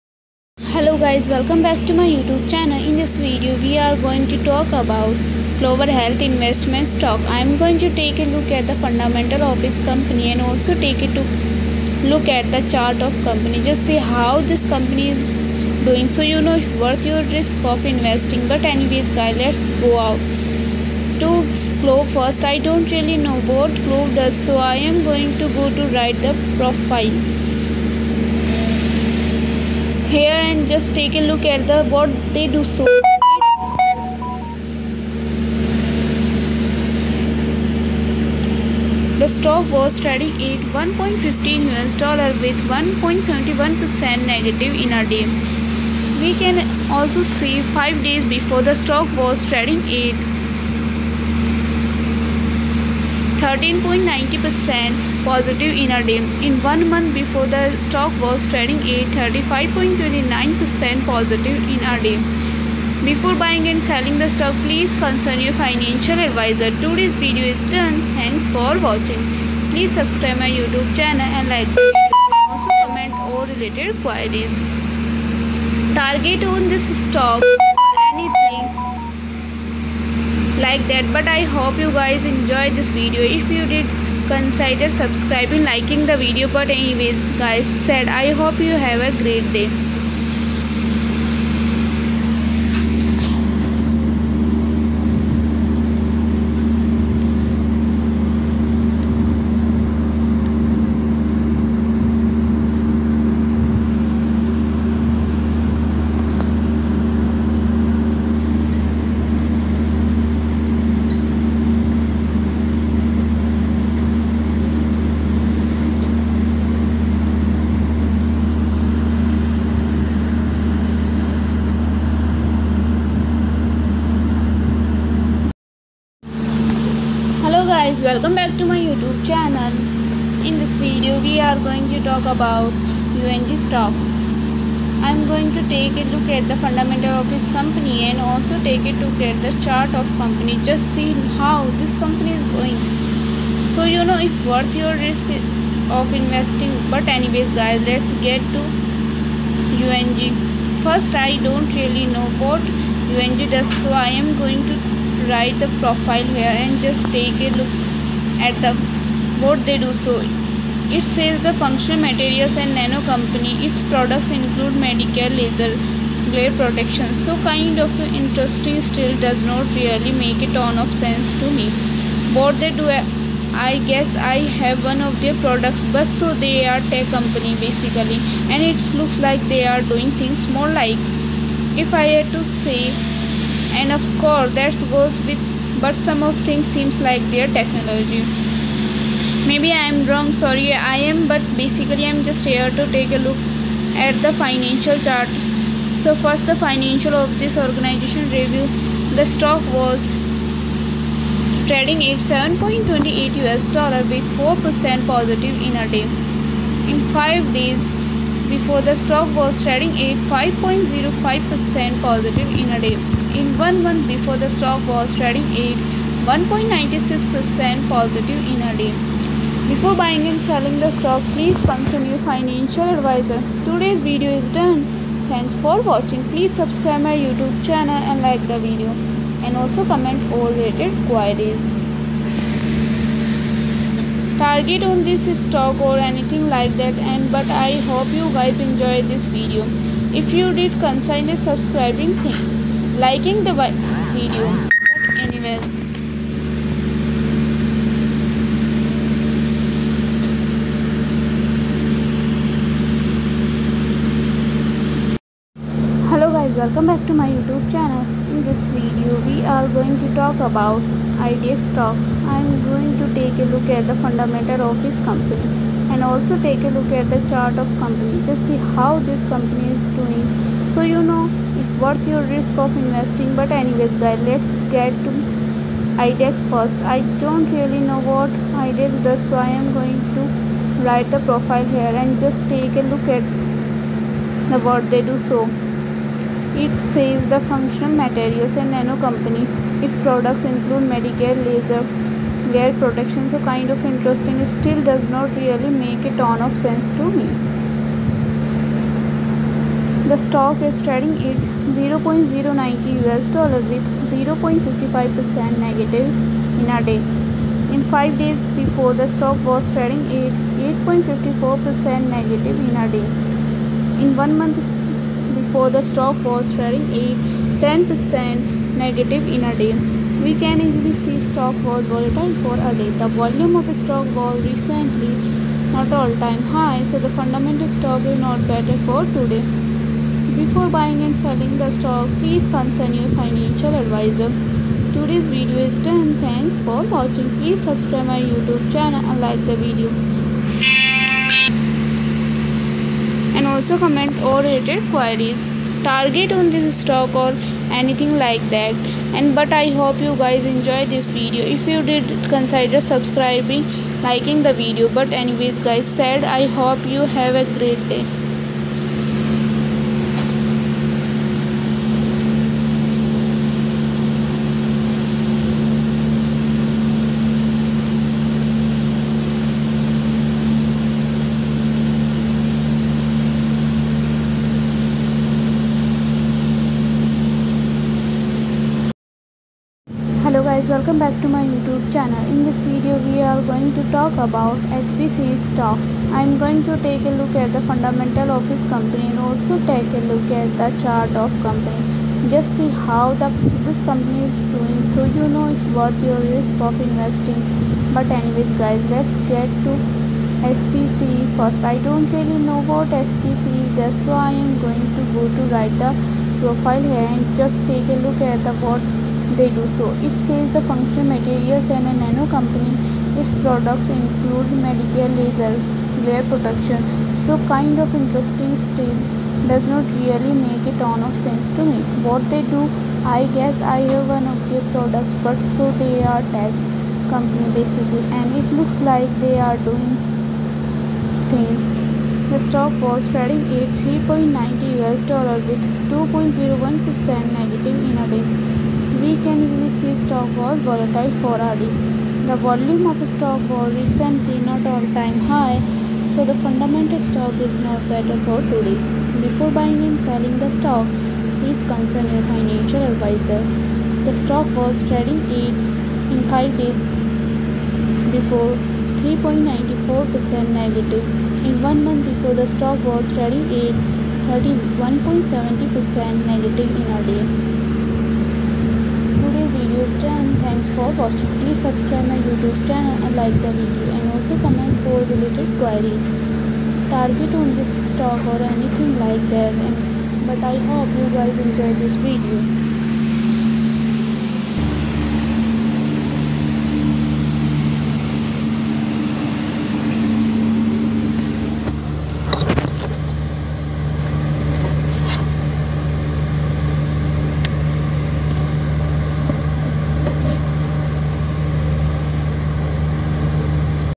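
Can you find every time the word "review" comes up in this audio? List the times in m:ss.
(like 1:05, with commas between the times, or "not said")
3:18.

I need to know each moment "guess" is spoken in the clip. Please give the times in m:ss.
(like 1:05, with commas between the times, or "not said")
2:53, 7:03.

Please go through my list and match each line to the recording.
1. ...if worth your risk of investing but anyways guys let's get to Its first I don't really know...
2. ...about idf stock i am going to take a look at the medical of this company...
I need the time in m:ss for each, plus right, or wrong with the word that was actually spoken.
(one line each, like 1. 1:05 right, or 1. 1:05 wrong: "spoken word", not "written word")
1. 2:24 wrong: "UNG", not "Its"
2. 4:20 wrong: "fundamental", not "medical".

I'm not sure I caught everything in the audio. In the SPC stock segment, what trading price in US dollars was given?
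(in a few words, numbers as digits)
$3.90.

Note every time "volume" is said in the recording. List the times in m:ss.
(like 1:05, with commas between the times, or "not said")
5:23, 7:22.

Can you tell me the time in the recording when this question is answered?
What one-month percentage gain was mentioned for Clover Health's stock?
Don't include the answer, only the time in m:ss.
0:59.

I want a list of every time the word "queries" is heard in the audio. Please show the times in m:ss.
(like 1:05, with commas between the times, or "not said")
1:14, 3:51, 5:44, 7:55.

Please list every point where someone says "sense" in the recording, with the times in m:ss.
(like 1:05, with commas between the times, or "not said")
2:51, 4:56, 7:01.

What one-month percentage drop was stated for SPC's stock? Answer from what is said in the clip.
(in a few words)
31.70%.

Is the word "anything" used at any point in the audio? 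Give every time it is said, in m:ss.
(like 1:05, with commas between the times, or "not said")
3:55, 5:47, 7:58.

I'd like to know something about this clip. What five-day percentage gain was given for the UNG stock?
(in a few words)
5.05%.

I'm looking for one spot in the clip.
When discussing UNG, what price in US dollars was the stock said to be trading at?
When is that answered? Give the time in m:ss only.
3:22.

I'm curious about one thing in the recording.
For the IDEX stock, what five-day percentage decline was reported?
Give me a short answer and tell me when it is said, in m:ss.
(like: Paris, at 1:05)
8.54%, at 5:10.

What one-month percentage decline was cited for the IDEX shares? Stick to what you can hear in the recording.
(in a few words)
10%.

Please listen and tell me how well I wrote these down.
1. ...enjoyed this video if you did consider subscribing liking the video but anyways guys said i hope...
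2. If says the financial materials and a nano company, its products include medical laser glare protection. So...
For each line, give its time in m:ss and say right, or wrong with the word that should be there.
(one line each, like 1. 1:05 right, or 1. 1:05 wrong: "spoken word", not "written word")
1. 1:22 right
2. 6:50 wrong: "functional", not "financial".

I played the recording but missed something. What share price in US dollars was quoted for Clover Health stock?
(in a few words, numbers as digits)
$1.15.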